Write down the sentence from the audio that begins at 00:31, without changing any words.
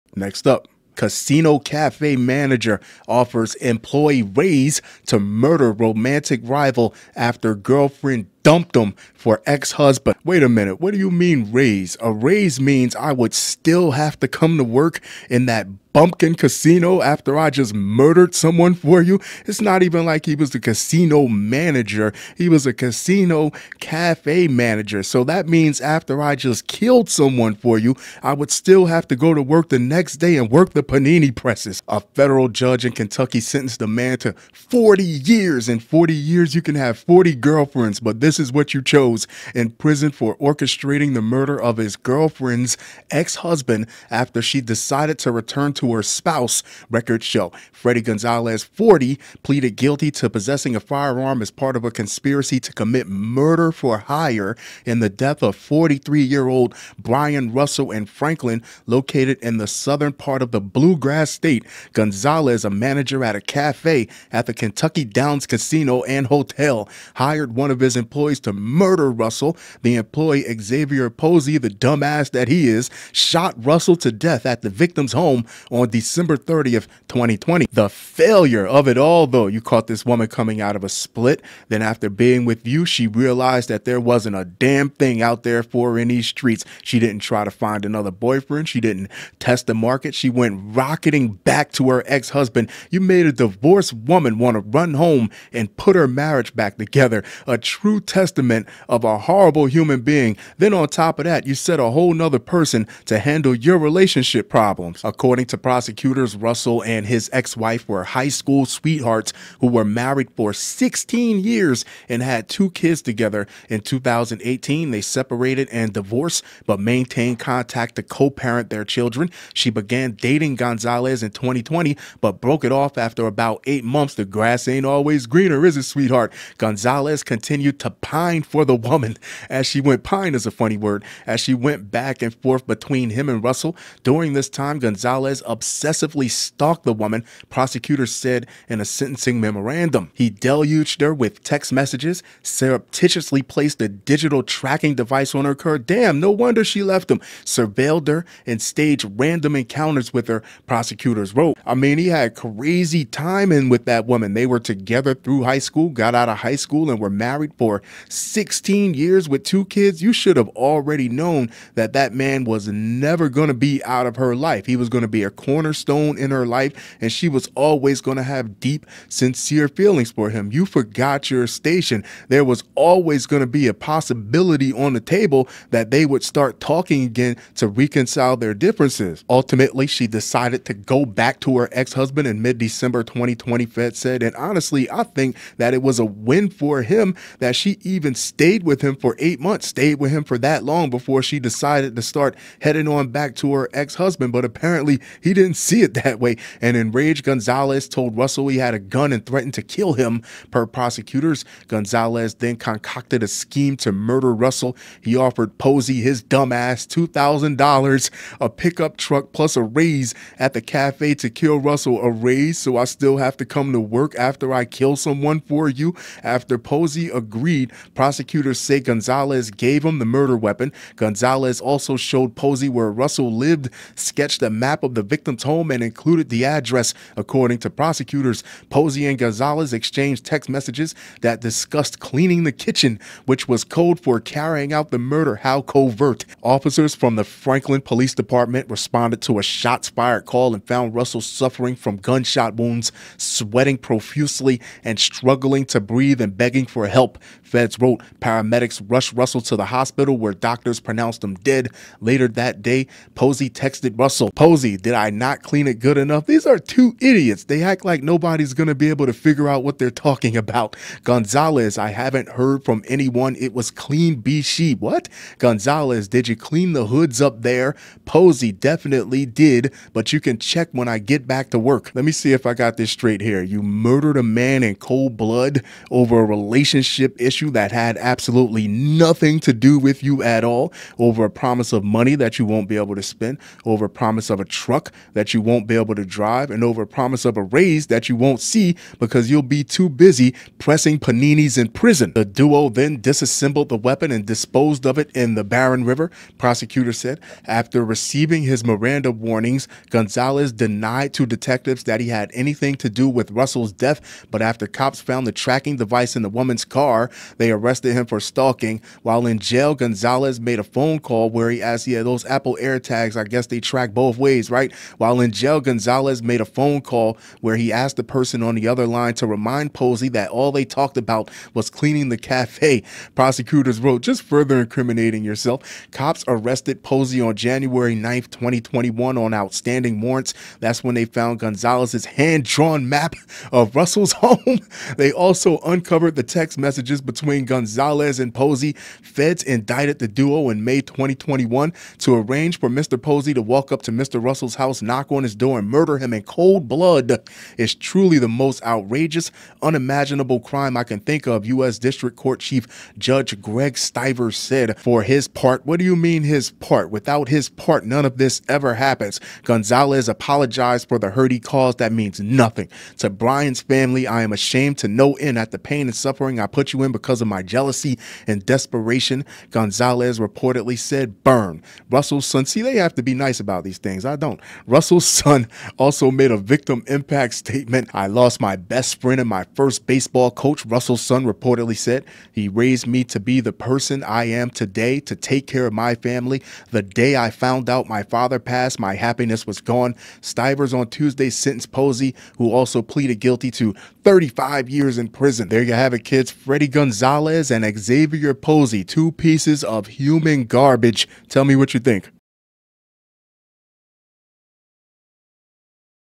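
A federal judge in Kentucky sentenced a man to 40 years.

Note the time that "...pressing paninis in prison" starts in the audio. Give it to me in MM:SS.
04:50.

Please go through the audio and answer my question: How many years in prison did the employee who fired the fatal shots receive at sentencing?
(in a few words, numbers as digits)
35 years.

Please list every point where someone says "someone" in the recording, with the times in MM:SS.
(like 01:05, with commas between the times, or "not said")
00:18, 00:27, 03:34.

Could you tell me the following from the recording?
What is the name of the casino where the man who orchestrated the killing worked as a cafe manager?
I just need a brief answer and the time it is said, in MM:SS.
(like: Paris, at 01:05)
Kentucky Downs Casino and Hotel, at 01:04.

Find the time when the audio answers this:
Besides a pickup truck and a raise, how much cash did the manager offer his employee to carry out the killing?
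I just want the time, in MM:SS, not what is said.
03:26.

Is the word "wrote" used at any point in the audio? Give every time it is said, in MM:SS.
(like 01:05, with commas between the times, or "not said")
02:31, 04:07, 05:23.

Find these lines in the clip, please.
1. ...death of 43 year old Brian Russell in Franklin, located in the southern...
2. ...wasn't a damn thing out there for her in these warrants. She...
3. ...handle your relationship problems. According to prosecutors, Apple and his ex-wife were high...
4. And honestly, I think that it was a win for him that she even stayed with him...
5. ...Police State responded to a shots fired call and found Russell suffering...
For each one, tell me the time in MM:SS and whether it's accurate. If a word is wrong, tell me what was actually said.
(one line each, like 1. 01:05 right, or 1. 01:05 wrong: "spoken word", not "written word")
1. 00:55 right
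2. 01:23 wrong: "streets", not "warrants"
3. 01:43 wrong: "Russell", not "Apple"
4. 03:04 right
5. 03:57 wrong: "Department", not "State".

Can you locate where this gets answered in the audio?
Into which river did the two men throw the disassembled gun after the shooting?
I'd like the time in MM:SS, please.
04:55.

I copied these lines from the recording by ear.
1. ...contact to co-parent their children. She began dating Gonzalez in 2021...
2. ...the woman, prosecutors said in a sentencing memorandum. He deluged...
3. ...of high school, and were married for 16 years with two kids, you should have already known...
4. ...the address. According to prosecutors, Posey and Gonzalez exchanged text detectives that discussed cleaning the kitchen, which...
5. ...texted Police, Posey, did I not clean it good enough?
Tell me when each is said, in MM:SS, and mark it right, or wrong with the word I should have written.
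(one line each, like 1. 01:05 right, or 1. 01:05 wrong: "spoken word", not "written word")
1. 01:57 wrong: "2020", not "2021"
2. 02:16 right
3. 02:36 right
4. 03:46 wrong: "messages", not "detectives"
5. 04:13 wrong: "Russell", not "Police".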